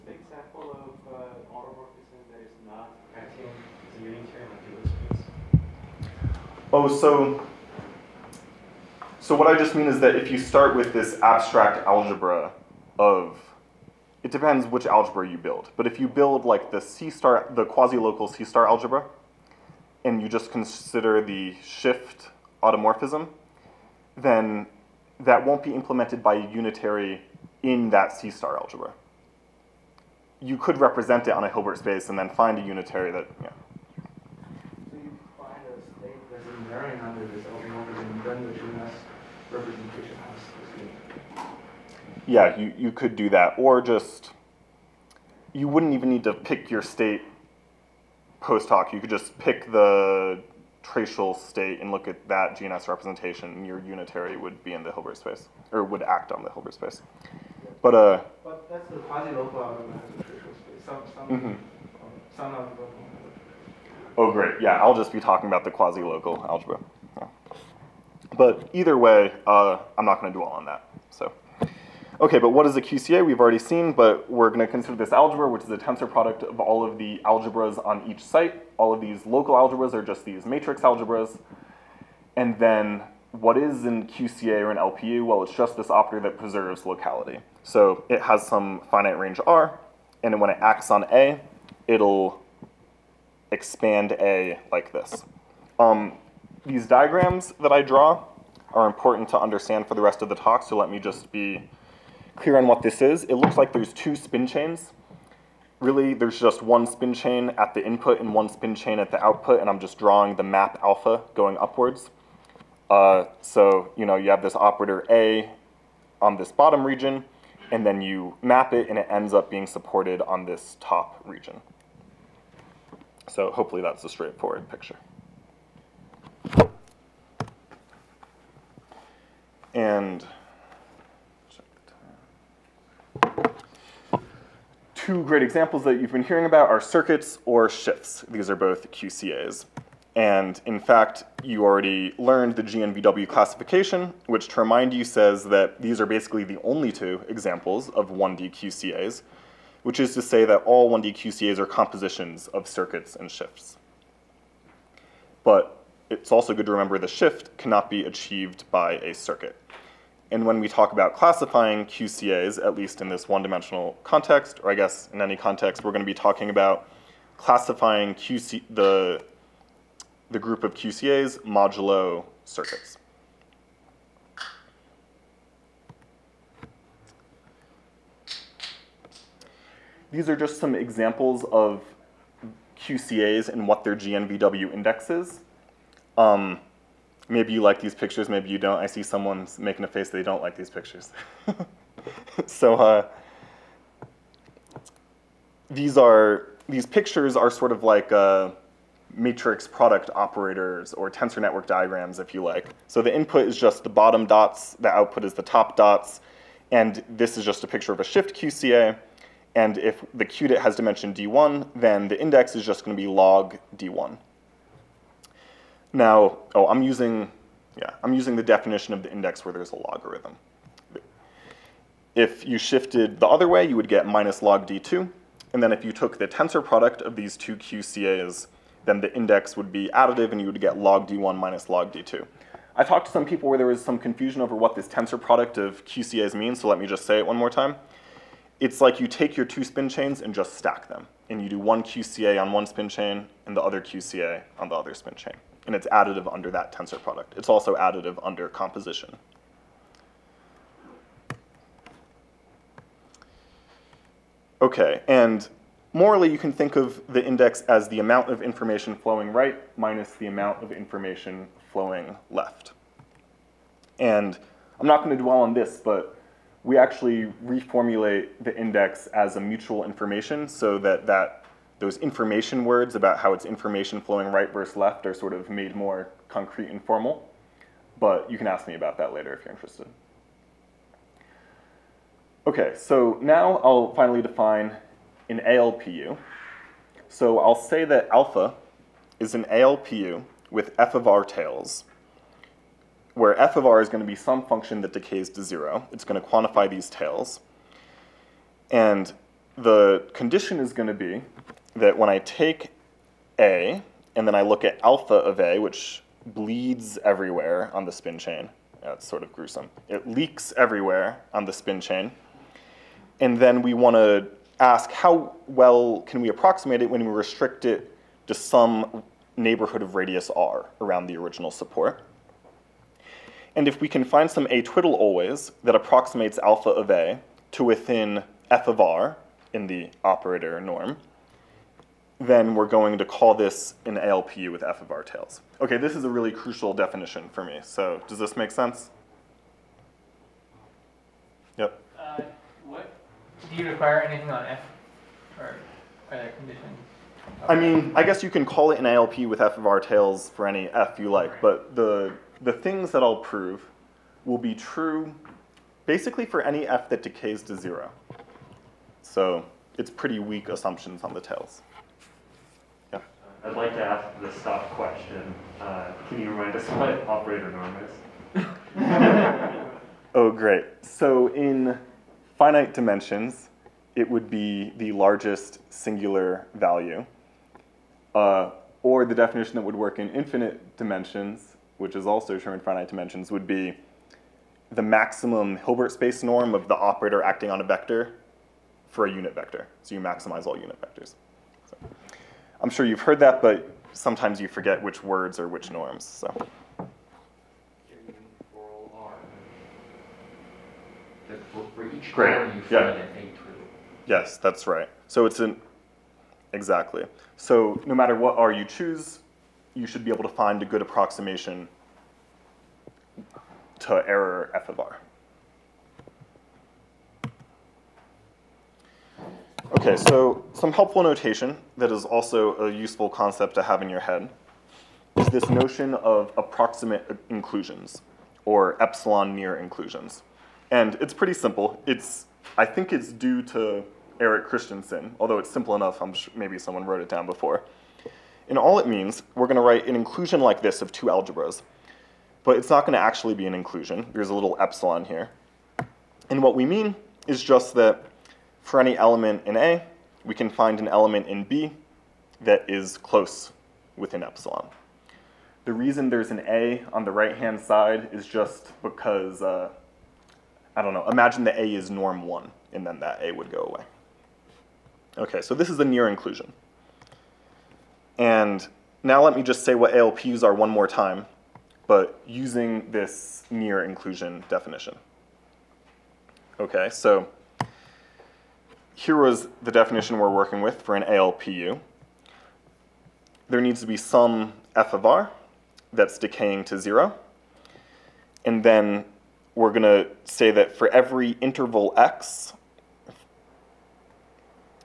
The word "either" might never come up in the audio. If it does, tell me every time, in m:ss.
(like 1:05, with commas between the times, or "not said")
1:08.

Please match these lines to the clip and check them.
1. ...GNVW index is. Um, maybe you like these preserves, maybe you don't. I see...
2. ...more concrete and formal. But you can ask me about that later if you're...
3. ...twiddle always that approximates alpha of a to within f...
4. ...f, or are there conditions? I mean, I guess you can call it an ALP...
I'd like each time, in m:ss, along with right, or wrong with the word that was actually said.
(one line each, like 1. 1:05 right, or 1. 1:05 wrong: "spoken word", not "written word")
1. 3:03 wrong: "pictures", not "preserves"
2. 4:35 right
3. 5:24 right
4. 5:44 right.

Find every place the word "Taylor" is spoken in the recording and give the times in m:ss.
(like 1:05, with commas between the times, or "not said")
not said.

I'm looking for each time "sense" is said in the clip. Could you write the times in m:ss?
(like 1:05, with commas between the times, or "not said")
5:38.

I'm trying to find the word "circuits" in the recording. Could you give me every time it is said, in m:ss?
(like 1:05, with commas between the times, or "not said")
2:16, 2:32, 2:39, 2:52.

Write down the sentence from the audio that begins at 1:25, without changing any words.
Well, it's just this operator that preserves locality.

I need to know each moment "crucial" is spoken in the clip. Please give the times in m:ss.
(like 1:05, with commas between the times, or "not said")
5:36.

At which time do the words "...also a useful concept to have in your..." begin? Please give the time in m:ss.
7:02.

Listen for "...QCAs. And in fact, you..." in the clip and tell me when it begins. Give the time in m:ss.
2:18.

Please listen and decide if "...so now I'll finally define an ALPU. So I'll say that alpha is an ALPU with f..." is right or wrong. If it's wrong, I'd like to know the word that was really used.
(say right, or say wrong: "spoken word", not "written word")
right.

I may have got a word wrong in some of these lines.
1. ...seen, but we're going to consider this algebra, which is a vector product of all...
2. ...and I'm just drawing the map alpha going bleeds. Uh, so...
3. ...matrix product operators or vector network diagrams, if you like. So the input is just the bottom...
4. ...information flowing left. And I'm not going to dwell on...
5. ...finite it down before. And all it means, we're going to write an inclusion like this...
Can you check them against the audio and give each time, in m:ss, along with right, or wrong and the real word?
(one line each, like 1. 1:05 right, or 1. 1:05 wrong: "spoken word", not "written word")
1. 1:13 wrong: "tensor", not "vector"
2. 1:49 wrong: "upwards", not "bleeds"
3. 3:19 wrong: "tensor", not "vector"
4. 4:20 right
5. 7:16 wrong: "wrote", not "finite".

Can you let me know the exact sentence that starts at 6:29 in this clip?
So you maximize all unit vectors.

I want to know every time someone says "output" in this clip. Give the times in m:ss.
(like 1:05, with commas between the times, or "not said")
1:49, 3:24.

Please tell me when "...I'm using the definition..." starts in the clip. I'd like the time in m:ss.
3:38.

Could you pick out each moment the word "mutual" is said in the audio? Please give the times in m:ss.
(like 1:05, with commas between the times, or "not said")
4:29.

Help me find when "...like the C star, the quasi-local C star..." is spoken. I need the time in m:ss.
0:16.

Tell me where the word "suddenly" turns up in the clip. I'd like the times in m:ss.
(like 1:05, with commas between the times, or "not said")
not said.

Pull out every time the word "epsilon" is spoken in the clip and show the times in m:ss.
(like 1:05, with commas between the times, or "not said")
7:08, 7:24, 7:34.